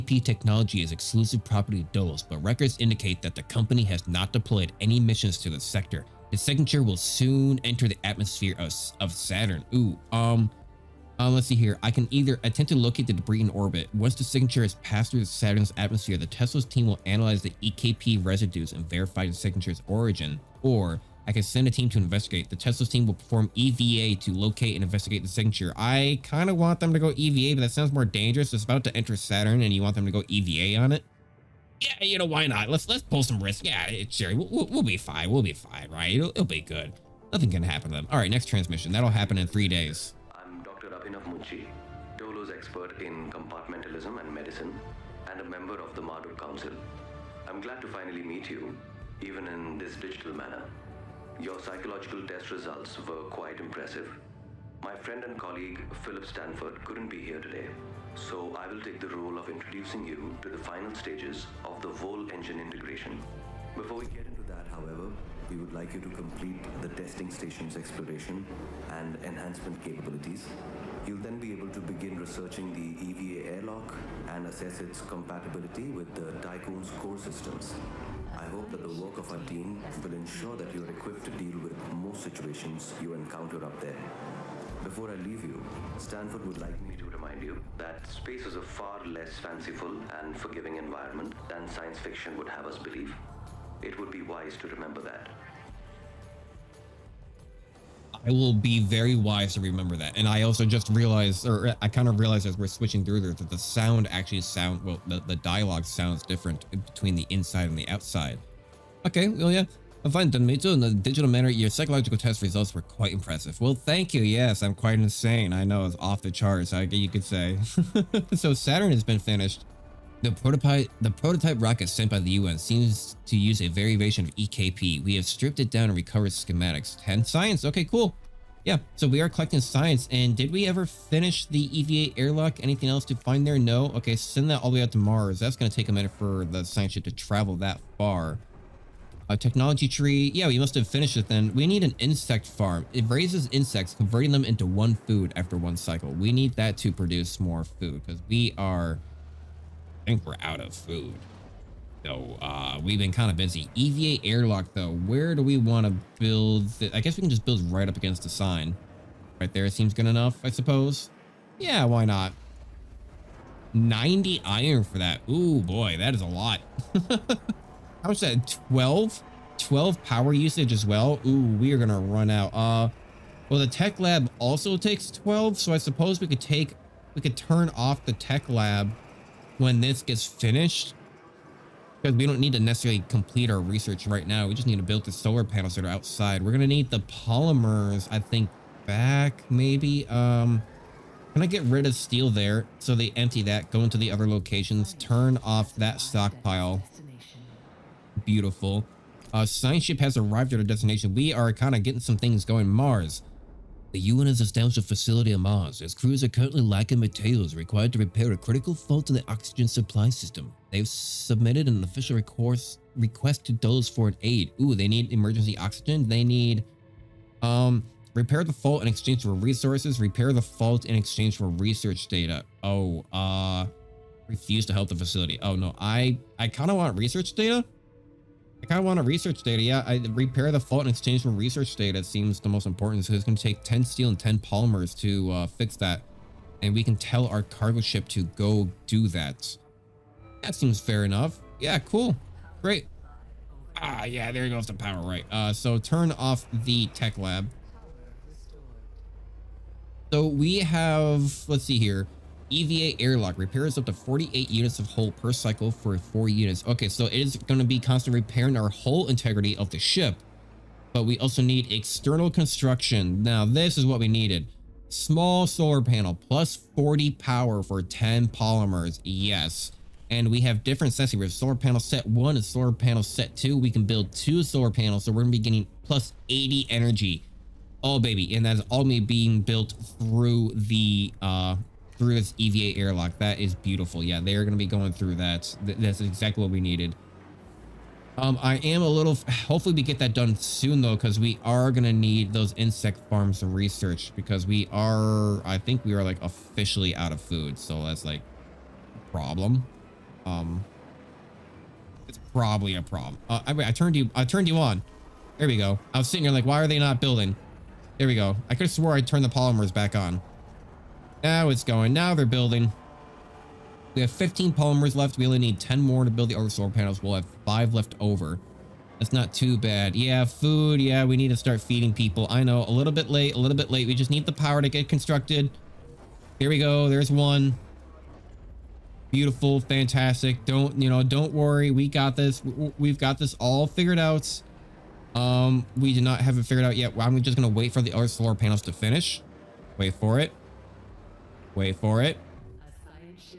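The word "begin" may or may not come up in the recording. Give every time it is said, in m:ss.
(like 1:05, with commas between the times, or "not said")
1:11.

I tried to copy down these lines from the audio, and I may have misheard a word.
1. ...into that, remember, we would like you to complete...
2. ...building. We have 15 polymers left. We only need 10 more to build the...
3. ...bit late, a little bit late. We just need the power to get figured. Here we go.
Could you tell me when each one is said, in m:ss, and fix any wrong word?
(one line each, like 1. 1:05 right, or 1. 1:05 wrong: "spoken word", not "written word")
1. 1:04 wrong: "however", not "remember"
2. 5:12 right
3. 5:22 wrong: "constructed", not "figured".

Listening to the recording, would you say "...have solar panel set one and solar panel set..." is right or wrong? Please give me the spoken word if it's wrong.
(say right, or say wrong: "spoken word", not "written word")
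right.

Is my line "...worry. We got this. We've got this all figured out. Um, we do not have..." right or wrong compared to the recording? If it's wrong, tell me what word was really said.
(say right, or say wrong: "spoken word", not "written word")
right.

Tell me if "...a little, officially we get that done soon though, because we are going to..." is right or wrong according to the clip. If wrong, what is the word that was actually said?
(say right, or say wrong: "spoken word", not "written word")
wrong: "hopefully", not "officially".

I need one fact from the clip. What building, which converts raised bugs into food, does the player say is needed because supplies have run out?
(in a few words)
Insect farm.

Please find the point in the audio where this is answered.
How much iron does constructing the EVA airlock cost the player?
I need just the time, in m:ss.
2:43.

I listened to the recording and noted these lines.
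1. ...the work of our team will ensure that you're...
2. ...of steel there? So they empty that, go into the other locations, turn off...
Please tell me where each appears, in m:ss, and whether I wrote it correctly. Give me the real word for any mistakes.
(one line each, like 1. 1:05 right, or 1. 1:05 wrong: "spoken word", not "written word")
1. 1:18 right
2. 3:11 right.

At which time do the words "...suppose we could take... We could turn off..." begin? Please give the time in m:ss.
2:55.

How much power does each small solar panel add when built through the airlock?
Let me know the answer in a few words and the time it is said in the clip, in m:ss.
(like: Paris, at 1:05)
40, at 4:26.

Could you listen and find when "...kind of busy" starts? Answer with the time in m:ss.
2:33.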